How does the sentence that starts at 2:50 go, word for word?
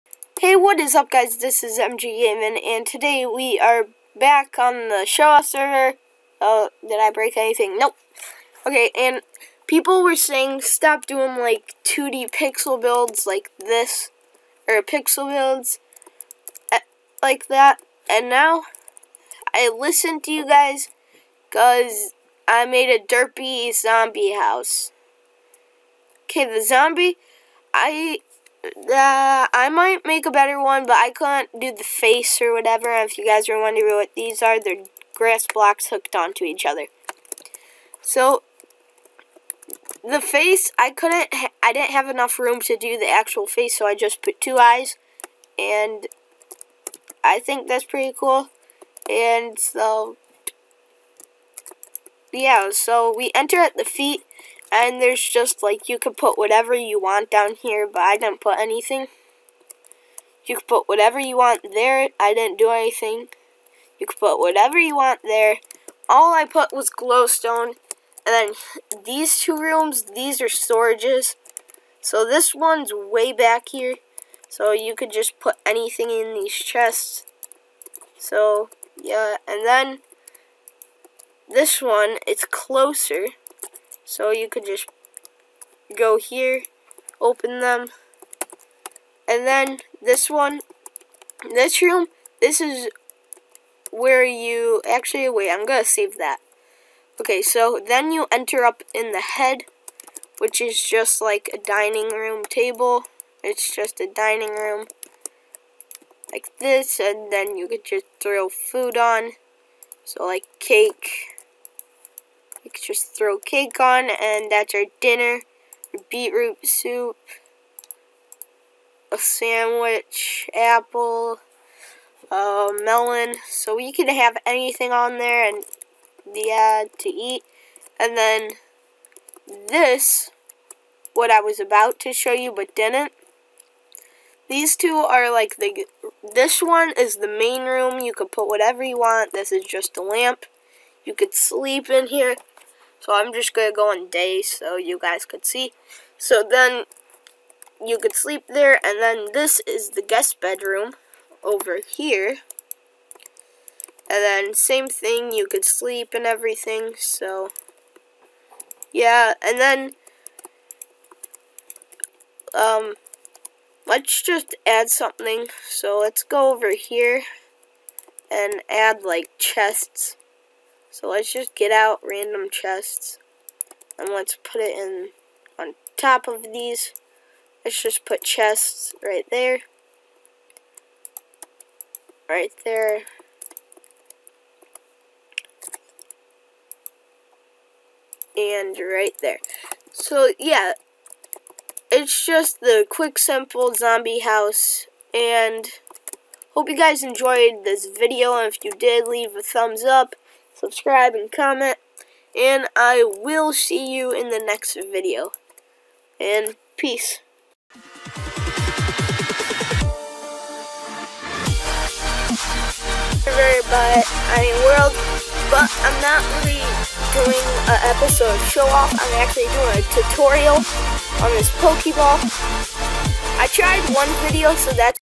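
So let's just get out random chests and let's put it in on top of these.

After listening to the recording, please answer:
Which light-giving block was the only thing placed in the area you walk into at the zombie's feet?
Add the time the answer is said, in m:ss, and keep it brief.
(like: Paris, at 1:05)
Glowstone, at 1:06.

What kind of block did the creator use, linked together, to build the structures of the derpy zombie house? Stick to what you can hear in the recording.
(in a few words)
Grass blocks.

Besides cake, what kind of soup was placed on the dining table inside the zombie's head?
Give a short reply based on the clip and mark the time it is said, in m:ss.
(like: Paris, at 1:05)
Beetroot soup, at 1:56.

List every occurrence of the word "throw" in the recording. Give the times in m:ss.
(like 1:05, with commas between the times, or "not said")
1:48, 1:53.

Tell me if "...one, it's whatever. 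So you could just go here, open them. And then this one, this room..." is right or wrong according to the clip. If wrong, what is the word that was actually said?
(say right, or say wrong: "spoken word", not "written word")
wrong: "closer", not "whatever".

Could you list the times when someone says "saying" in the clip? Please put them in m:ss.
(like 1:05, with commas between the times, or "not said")
0:10.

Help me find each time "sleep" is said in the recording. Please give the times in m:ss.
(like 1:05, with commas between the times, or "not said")
2:21, 2:28, 2:35.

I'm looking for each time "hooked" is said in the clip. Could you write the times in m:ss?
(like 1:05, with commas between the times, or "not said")
0:35.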